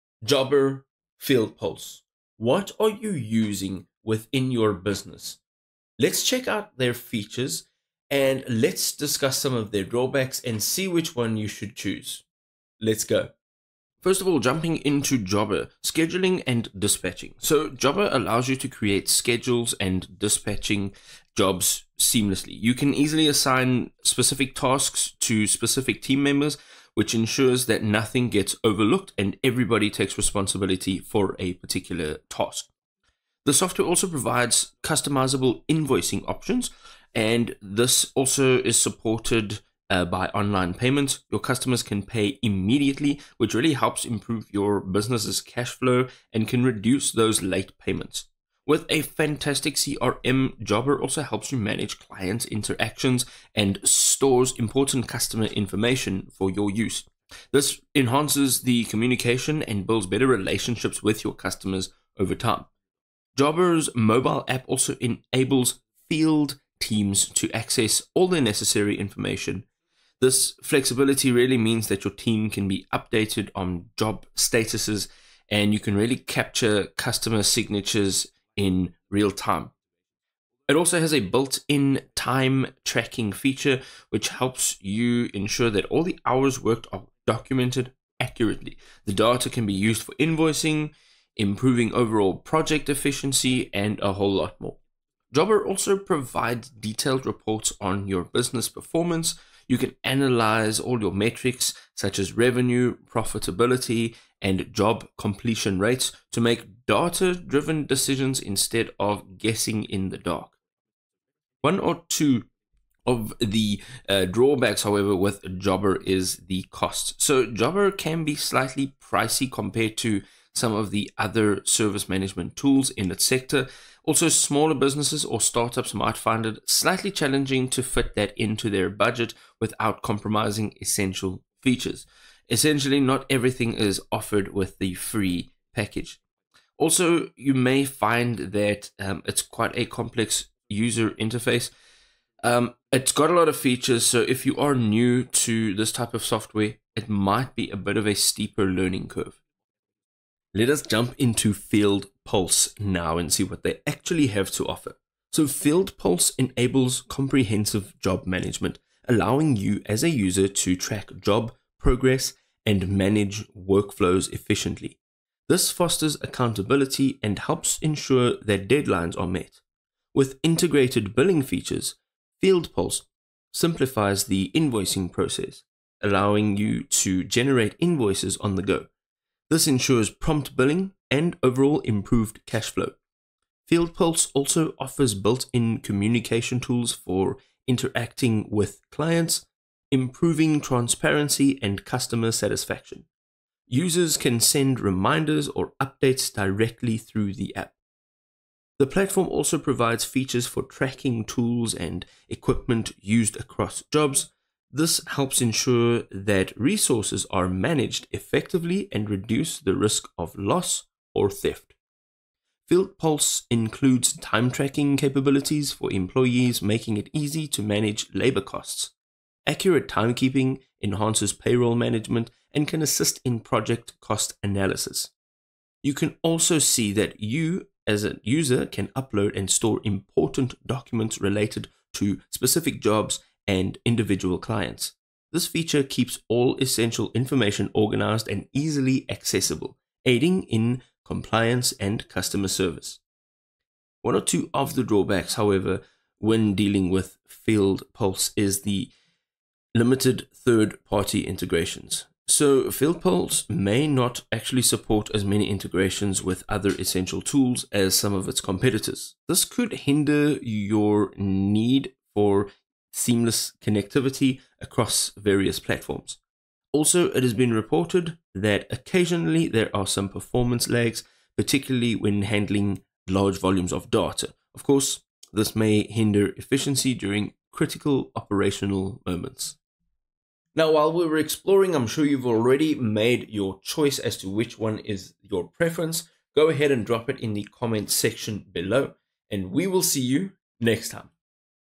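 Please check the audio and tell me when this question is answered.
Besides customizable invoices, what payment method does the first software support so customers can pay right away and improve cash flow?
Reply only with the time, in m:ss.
0:40.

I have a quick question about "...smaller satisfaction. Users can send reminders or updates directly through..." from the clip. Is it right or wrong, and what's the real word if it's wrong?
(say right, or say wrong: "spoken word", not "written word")
wrong: "customer", not "smaller".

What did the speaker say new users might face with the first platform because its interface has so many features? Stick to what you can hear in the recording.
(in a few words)
A steeper learning curve.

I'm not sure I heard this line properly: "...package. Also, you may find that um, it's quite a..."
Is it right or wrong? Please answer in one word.
right.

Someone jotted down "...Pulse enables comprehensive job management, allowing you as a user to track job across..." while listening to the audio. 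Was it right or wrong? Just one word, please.
wrong.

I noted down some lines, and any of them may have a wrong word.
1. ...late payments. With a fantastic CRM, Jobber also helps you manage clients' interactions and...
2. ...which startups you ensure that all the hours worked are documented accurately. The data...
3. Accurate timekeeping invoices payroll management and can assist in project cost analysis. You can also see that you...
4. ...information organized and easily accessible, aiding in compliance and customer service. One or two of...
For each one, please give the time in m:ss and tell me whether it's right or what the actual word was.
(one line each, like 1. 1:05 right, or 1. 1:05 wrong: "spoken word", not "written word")
1. 0:47 right
2. 1:24 wrong: "helps", not "startups"
3. 3:39 wrong: "enhances", not "invoices"
4. 3:57 right.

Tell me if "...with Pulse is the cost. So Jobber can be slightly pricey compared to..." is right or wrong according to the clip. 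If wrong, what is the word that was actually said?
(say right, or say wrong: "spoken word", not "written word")
wrong: "Jobber", not "Pulse".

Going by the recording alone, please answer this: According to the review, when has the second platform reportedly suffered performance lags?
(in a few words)
Handling large volumes of data.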